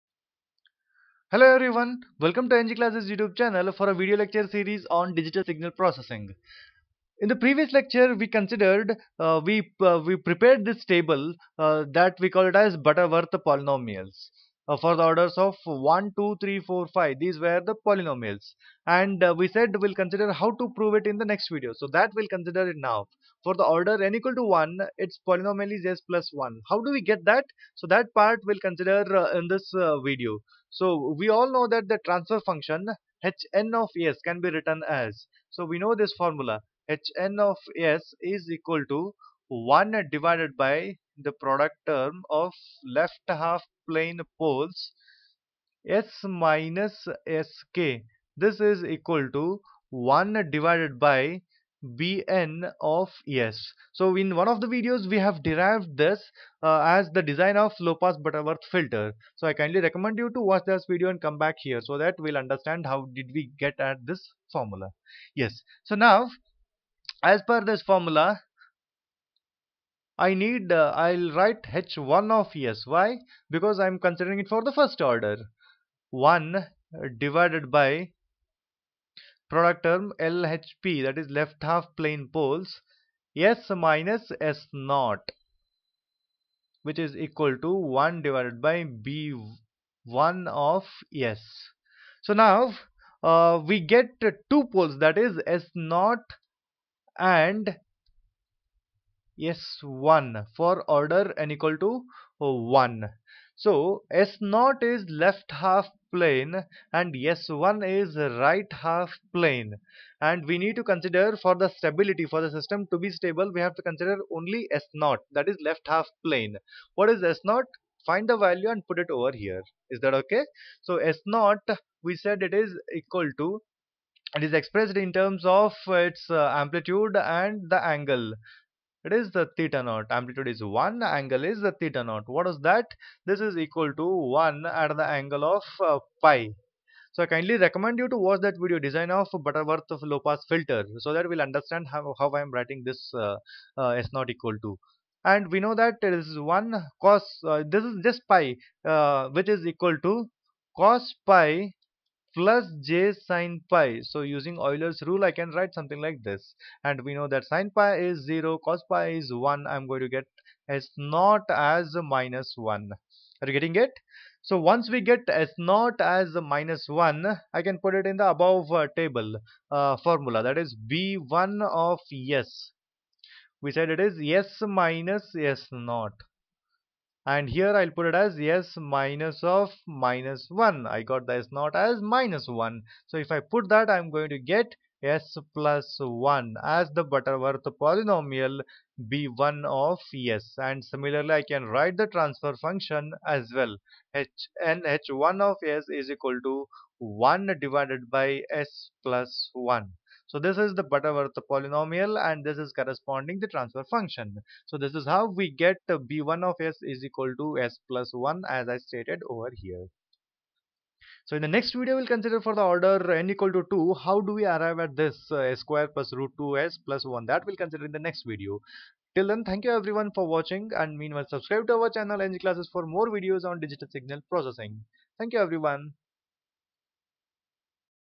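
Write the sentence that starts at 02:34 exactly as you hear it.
So using Euler's rule, I can write something like this.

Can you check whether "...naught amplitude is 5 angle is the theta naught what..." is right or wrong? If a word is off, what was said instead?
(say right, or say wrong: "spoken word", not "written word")
wrong: "1", not "5".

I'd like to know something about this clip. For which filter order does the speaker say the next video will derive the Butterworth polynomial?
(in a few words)
2.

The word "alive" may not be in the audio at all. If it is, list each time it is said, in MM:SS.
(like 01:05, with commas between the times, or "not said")
not said.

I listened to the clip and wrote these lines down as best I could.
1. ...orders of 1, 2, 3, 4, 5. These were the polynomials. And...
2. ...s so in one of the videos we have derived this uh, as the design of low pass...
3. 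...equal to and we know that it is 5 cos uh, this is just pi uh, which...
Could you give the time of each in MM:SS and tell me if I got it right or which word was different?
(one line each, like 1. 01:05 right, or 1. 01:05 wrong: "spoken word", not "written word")
1. 00:15 right
2. 00:53 right
3. 02:24 wrong: "1", not "5".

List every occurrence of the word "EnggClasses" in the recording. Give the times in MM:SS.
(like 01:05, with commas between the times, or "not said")
00:02, 03:42.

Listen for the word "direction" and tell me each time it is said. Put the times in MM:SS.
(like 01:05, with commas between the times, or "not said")
not said.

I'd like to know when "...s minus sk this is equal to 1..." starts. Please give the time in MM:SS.
00:45.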